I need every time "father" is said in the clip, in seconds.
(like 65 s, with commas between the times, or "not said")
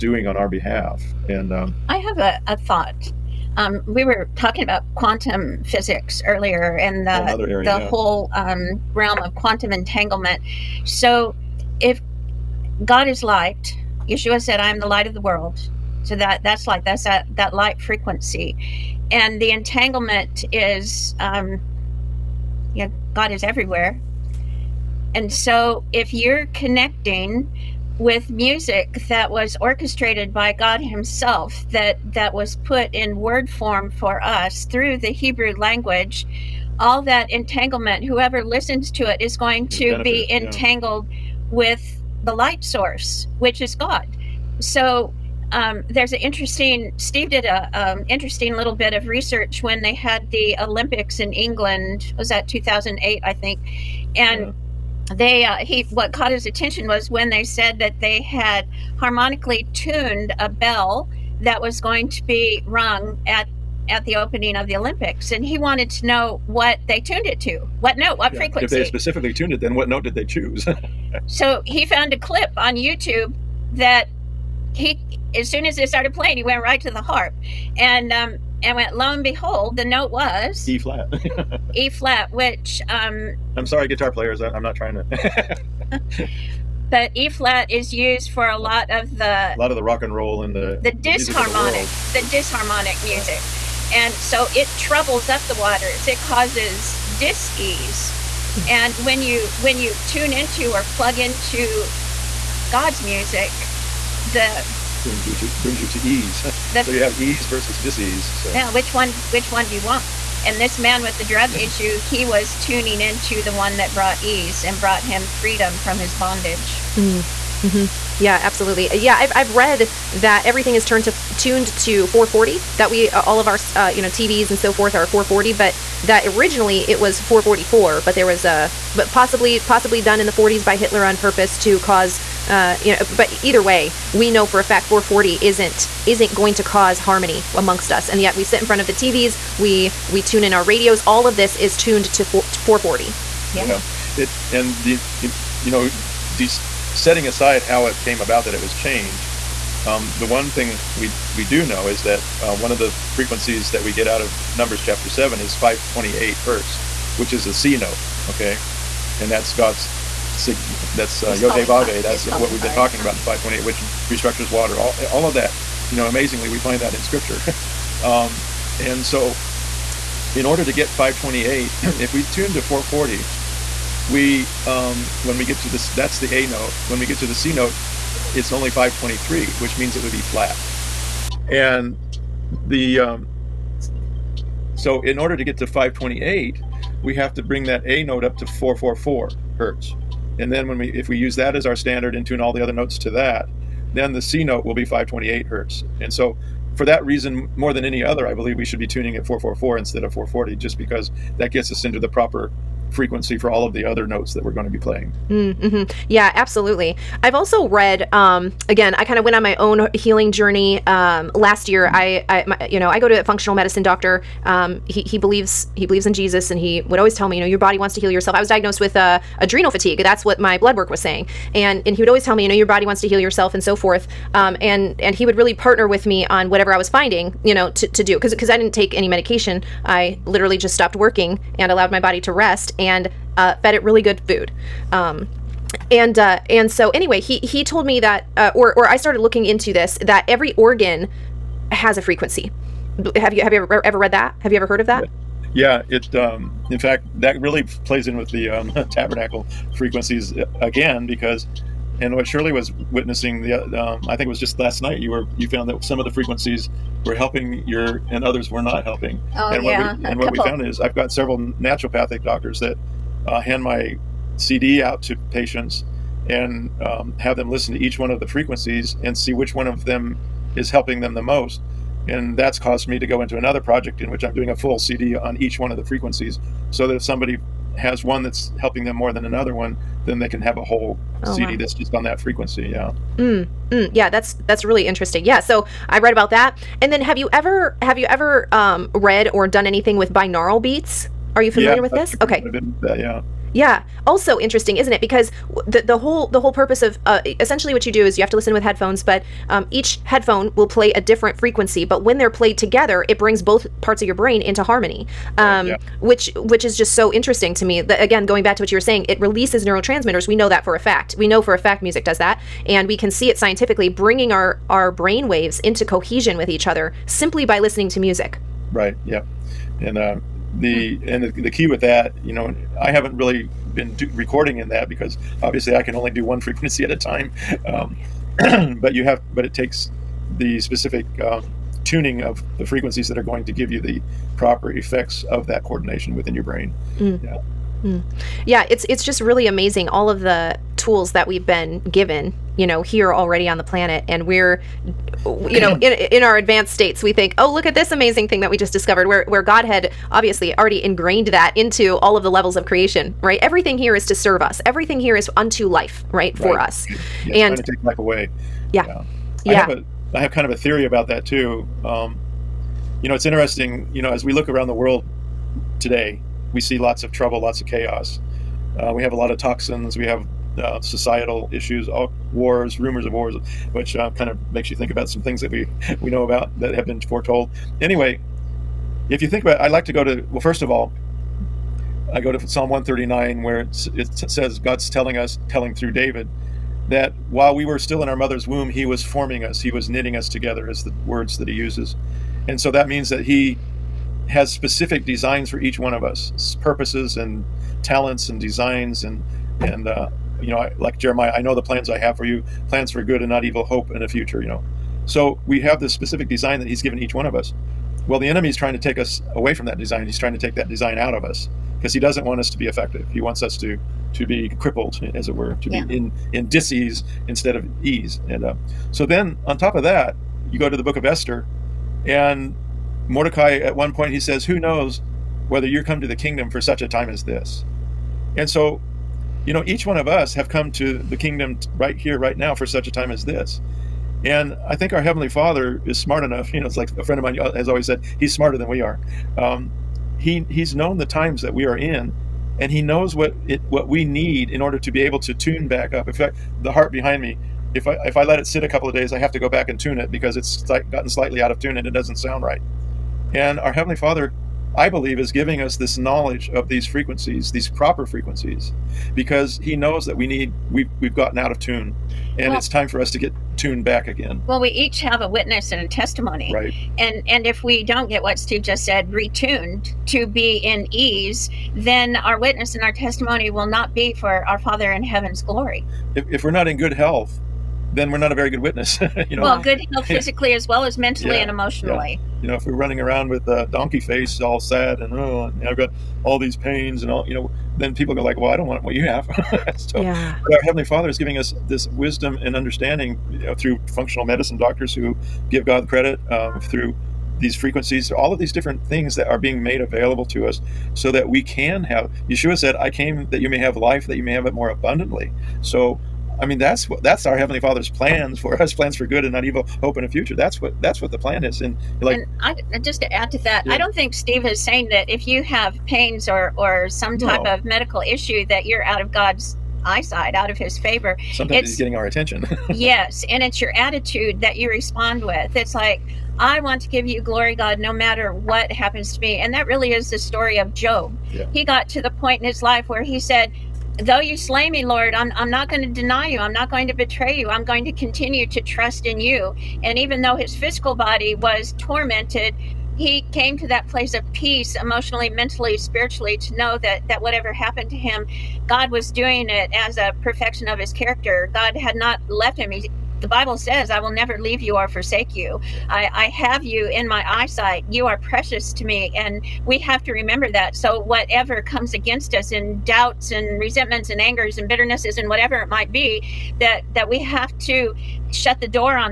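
435 s, 453 s, 474 s, 490 s, 507 s.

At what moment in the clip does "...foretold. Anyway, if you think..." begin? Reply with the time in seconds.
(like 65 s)
376 s.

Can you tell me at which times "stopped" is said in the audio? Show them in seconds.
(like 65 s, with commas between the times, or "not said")
230 s.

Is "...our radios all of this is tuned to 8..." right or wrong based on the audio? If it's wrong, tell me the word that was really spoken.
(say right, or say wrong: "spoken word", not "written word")
wrong: "4", not "8".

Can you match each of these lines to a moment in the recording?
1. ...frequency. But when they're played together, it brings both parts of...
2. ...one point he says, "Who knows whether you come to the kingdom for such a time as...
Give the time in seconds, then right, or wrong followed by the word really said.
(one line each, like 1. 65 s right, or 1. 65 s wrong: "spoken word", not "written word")
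1. 301 s right
2. 423 s right.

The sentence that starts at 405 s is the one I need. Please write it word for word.
So we have this specific design that he's given each one of us.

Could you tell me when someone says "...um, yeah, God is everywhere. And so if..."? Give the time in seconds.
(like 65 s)
21 s.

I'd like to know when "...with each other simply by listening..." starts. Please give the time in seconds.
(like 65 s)
316 s.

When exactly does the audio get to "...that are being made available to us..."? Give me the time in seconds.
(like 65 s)
499 s.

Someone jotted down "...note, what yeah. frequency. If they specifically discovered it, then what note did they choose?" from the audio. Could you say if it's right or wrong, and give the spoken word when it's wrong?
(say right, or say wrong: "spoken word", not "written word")
wrong: "tuned", not "discovered".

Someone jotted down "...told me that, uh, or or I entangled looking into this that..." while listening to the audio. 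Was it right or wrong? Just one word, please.
wrong.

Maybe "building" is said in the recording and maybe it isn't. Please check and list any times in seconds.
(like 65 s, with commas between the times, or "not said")
not said.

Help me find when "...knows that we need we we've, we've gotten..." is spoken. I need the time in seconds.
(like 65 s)
459 s.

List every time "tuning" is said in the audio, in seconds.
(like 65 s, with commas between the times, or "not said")
112 s, 198 s, 331 s.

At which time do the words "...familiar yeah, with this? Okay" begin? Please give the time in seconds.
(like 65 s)
291 s.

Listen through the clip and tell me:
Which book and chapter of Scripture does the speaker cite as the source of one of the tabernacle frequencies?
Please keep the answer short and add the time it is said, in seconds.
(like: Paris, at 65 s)
Numbers chapter 7, at 154 s.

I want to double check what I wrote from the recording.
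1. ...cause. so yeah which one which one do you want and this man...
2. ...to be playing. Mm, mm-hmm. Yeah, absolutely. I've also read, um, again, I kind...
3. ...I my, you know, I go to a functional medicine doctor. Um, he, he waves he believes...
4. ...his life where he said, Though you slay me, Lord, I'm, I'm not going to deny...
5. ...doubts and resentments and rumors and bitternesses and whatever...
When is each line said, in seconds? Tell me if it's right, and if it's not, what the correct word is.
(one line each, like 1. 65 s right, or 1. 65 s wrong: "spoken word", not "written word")
1. 107 s wrong: "disease", not "cause"
2. 204 s right
3. 212 s wrong: "believes", not "waves"
4. 532 s right
5. 562 s wrong: "angers", not "rumors".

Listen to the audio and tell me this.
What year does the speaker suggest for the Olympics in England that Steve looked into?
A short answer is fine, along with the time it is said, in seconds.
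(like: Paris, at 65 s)
2008, at 52 s.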